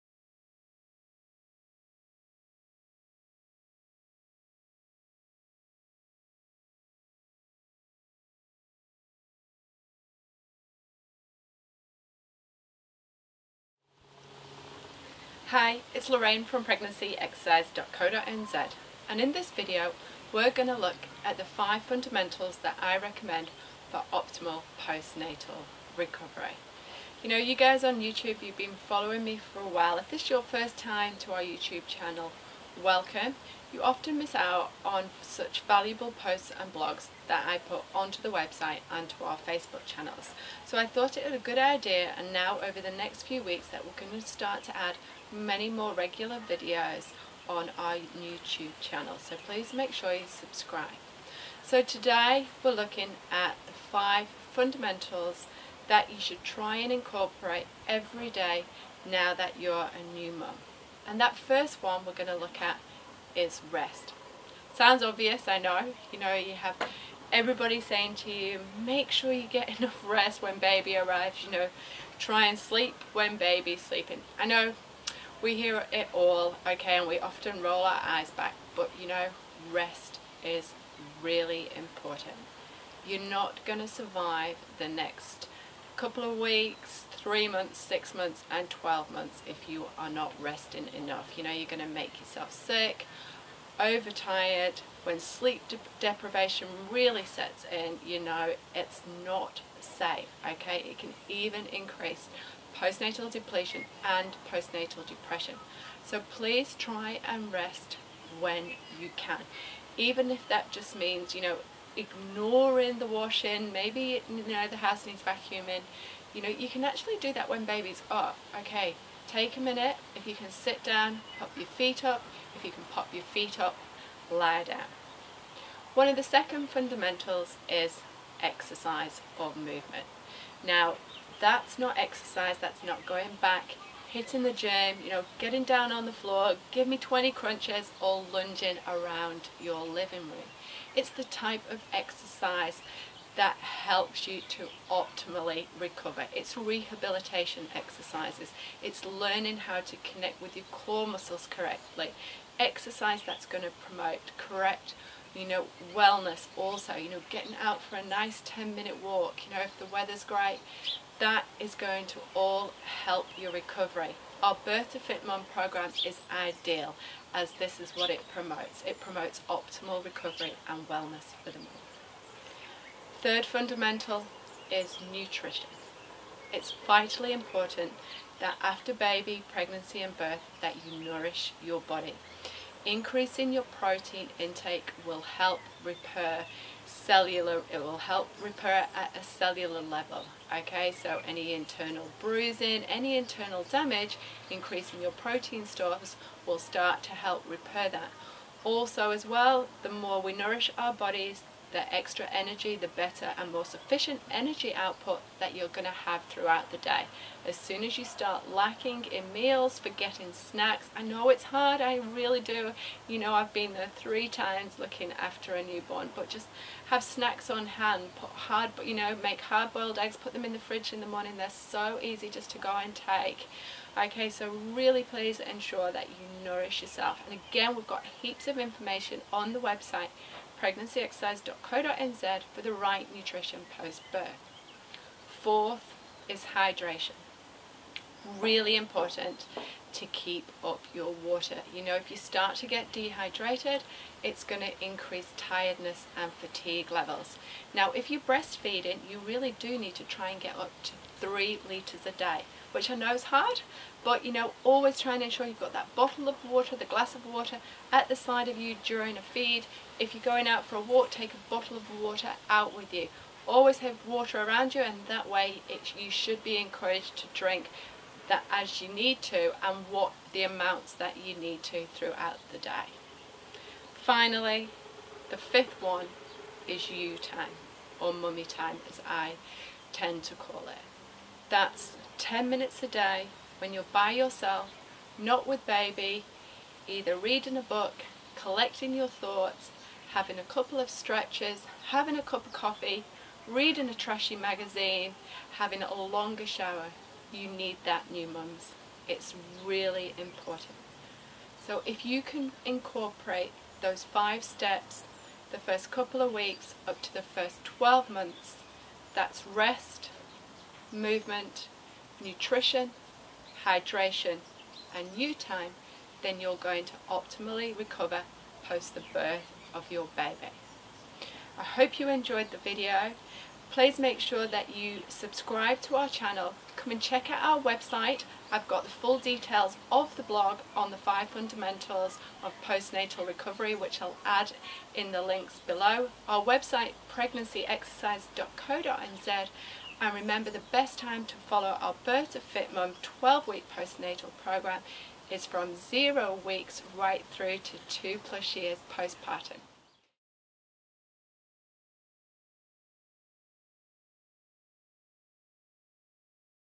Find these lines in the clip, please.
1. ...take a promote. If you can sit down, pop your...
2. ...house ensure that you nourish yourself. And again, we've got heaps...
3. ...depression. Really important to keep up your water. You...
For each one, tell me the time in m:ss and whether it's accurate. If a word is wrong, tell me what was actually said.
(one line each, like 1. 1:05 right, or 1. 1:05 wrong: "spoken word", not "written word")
1. 1:59 wrong: "minute", not "promote"
2. 3:45 wrong: "please", not "house"
3. 3:56 wrong: "hydration", not "depression".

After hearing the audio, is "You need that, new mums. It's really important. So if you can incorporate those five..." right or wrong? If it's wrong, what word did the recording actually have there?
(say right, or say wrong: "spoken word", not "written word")
right.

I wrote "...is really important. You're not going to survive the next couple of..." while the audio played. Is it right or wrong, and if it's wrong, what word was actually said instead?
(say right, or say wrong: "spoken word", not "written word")
right.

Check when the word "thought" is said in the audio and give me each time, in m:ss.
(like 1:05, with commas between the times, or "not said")
0:40, 4:49.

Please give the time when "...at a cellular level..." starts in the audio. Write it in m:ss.
3:08.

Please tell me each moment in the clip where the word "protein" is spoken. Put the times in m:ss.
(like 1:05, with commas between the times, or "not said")
3:03, 3:15.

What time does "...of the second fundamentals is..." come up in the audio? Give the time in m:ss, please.
2:06.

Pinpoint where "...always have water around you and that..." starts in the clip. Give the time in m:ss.
4:23.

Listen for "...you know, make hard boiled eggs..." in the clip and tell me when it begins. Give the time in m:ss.
3:38.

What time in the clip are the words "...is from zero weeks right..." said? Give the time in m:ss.
5:45.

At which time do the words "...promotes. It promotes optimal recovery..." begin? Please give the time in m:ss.
2:48.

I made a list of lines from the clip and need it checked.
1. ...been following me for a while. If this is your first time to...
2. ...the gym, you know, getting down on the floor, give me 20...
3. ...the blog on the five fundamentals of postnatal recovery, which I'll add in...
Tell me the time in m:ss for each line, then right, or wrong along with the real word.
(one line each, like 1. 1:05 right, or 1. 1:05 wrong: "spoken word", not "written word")
1. 0:28 right
2. 2:14 right
3. 5:30 right.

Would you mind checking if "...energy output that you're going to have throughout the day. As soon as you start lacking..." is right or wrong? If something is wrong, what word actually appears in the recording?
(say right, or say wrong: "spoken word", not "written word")
right.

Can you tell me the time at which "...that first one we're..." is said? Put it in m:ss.
1:01.